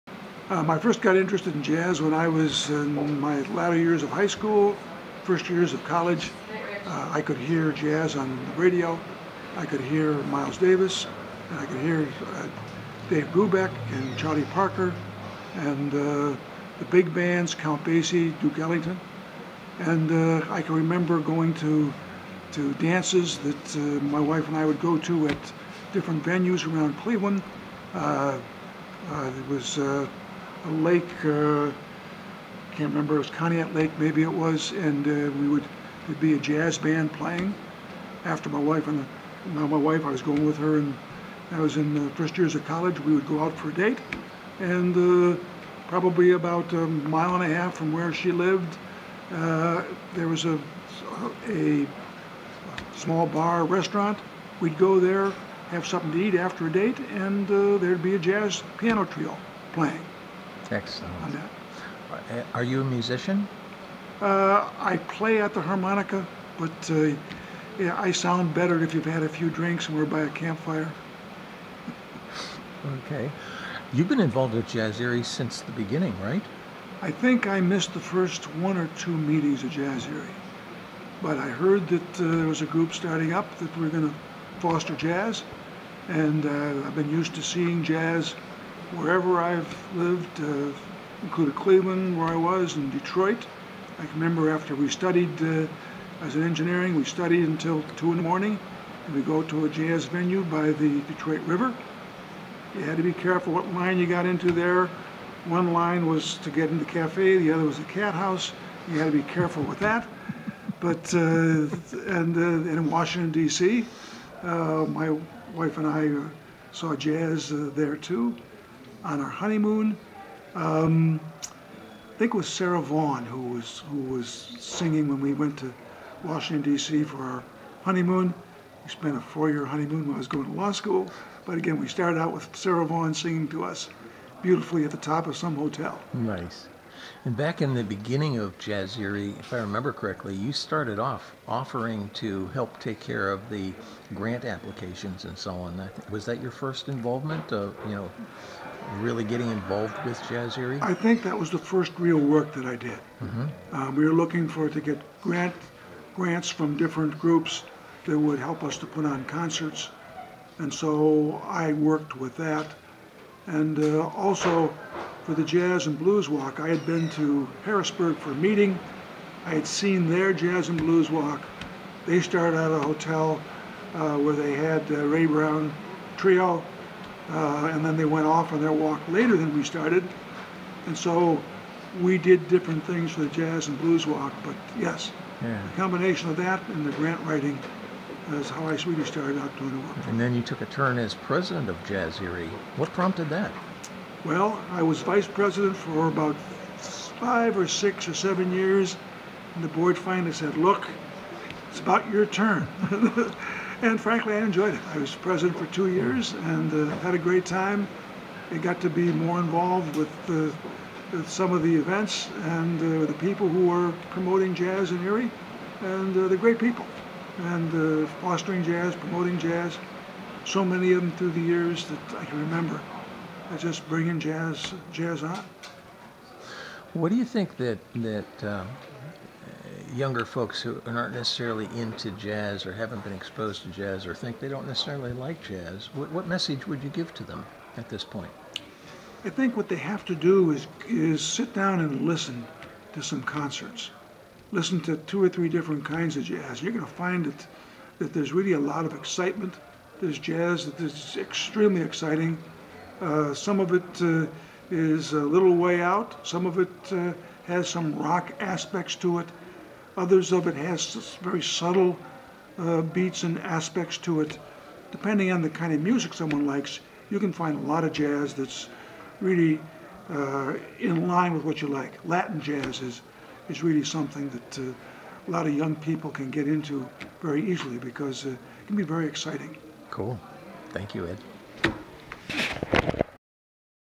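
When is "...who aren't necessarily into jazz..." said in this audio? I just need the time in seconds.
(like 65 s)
230 s.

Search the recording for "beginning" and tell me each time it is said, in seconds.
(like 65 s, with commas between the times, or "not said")
75 s, 137 s.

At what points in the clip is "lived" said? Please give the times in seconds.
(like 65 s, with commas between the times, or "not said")
48 s, 89 s.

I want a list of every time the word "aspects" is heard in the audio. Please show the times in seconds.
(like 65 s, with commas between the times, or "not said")
258 s, 263 s.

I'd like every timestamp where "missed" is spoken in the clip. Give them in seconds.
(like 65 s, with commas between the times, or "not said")
77 s.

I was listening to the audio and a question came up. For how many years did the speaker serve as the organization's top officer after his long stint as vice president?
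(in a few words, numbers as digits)
2.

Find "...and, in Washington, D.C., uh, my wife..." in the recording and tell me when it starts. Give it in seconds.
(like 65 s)
112 s.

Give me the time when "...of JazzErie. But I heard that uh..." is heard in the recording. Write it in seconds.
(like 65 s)
79 s.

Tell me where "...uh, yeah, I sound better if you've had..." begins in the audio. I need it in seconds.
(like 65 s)
66 s.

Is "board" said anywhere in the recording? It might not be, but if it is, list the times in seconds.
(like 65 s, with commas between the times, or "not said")
199 s.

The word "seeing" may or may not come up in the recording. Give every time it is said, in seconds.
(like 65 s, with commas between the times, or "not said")
87 s.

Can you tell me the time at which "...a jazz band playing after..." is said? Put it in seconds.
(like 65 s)
36 s.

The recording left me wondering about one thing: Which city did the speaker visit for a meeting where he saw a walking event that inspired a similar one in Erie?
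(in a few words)
Harrisburg.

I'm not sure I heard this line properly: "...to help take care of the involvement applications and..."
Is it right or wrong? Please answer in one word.
wrong.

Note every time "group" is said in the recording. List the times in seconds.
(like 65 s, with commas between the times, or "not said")
82 s, 157 s.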